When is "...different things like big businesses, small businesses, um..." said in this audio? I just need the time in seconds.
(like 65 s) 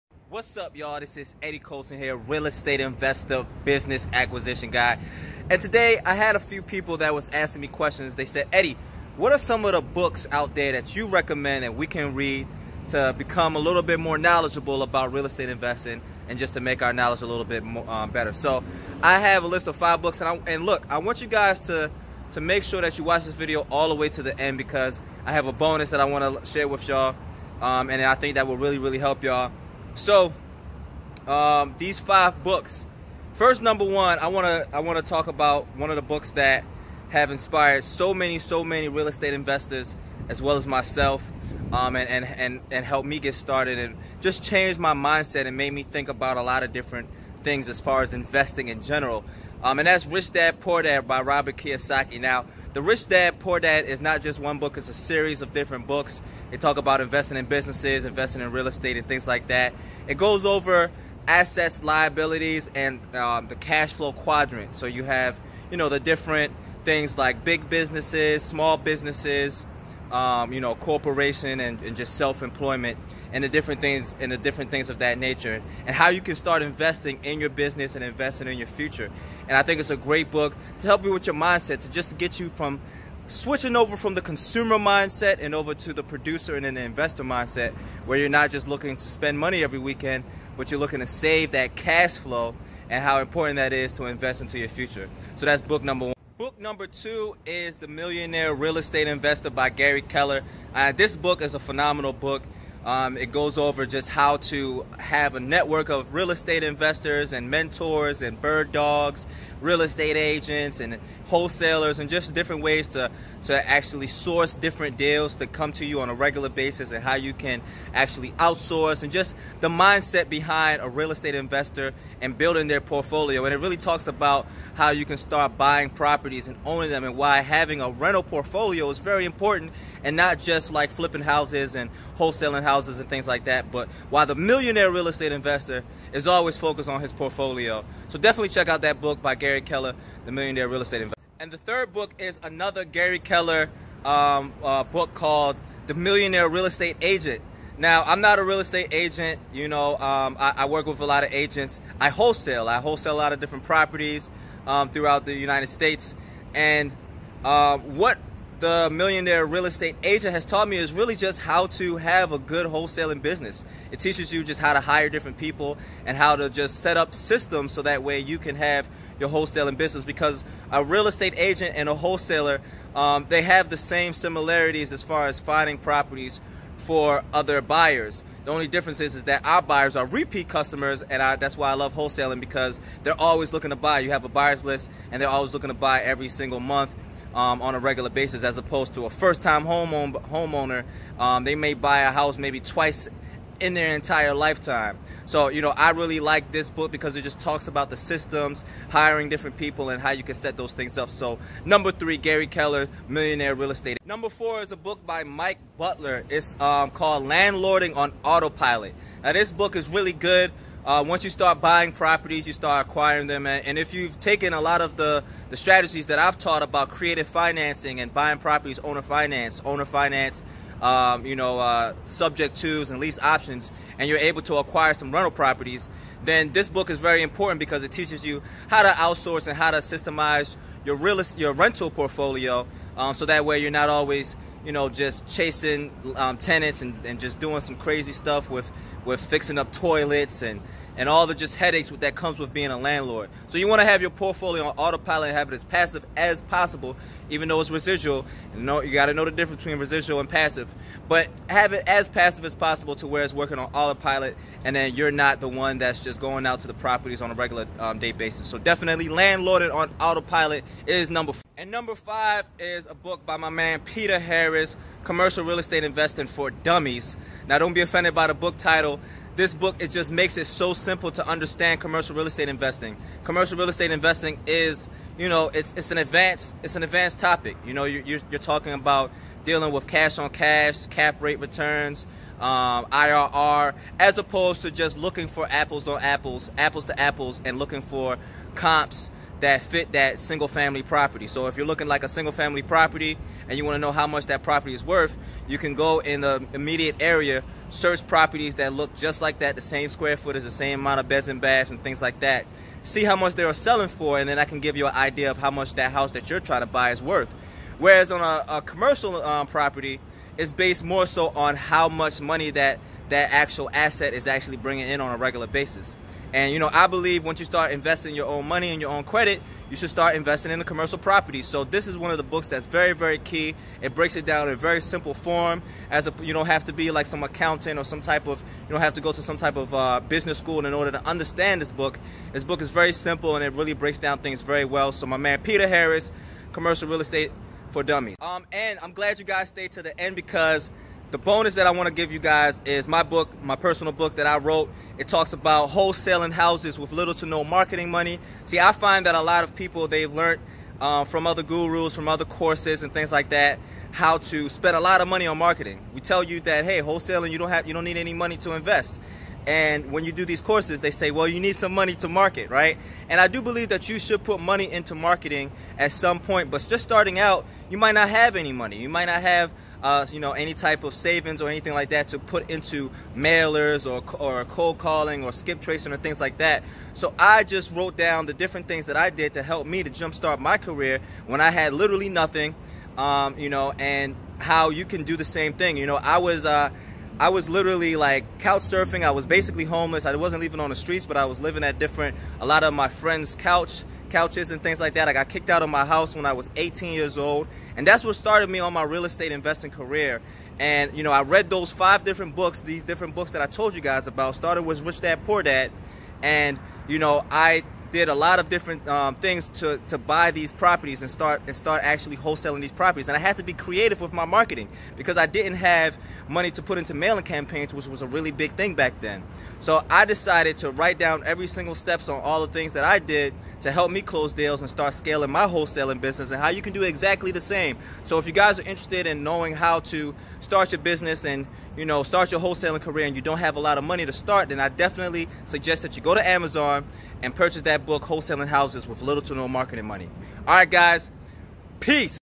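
65 s.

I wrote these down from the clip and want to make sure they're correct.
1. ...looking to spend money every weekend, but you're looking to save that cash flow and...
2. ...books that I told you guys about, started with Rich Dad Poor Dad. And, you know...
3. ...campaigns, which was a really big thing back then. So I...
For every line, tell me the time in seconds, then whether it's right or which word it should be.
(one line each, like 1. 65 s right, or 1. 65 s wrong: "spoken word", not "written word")
1. 88 s right
2. 403 s right
3. 417 s right.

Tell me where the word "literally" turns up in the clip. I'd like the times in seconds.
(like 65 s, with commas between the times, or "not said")
381 s, 387 s.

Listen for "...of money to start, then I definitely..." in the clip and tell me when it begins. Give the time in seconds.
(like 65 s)
433 s.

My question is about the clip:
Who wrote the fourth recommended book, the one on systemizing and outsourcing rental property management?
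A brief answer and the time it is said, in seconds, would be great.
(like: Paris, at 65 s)
Mike Butler, at 205 s.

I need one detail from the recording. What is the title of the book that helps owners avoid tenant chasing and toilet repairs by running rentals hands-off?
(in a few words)
Landlording on Autopilot.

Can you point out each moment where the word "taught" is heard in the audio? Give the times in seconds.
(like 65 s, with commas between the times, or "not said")
160 s, 216 s.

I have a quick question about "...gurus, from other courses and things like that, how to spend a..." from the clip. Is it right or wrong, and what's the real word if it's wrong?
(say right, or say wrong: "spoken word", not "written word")
right.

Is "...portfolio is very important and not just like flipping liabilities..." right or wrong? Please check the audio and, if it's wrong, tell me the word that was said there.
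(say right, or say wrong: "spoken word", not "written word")
wrong: "houses", not "liabilities".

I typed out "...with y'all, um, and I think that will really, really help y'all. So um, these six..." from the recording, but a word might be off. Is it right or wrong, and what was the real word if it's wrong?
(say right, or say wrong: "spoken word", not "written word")
wrong: "five", not "six".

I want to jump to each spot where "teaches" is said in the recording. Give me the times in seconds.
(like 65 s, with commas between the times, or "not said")
163 s, 227 s.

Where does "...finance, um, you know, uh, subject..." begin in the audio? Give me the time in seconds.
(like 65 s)
219 s.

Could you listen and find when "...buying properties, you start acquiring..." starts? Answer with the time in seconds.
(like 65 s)
211 s.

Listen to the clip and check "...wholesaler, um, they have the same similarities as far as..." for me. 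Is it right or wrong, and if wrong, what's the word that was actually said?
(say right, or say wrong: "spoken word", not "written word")
right.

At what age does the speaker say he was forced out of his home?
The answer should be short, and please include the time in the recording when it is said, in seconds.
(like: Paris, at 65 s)
18, at 396 s.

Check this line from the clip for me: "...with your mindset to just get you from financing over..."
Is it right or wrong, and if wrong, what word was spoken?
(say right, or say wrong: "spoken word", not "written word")
wrong: "switching", not "financing".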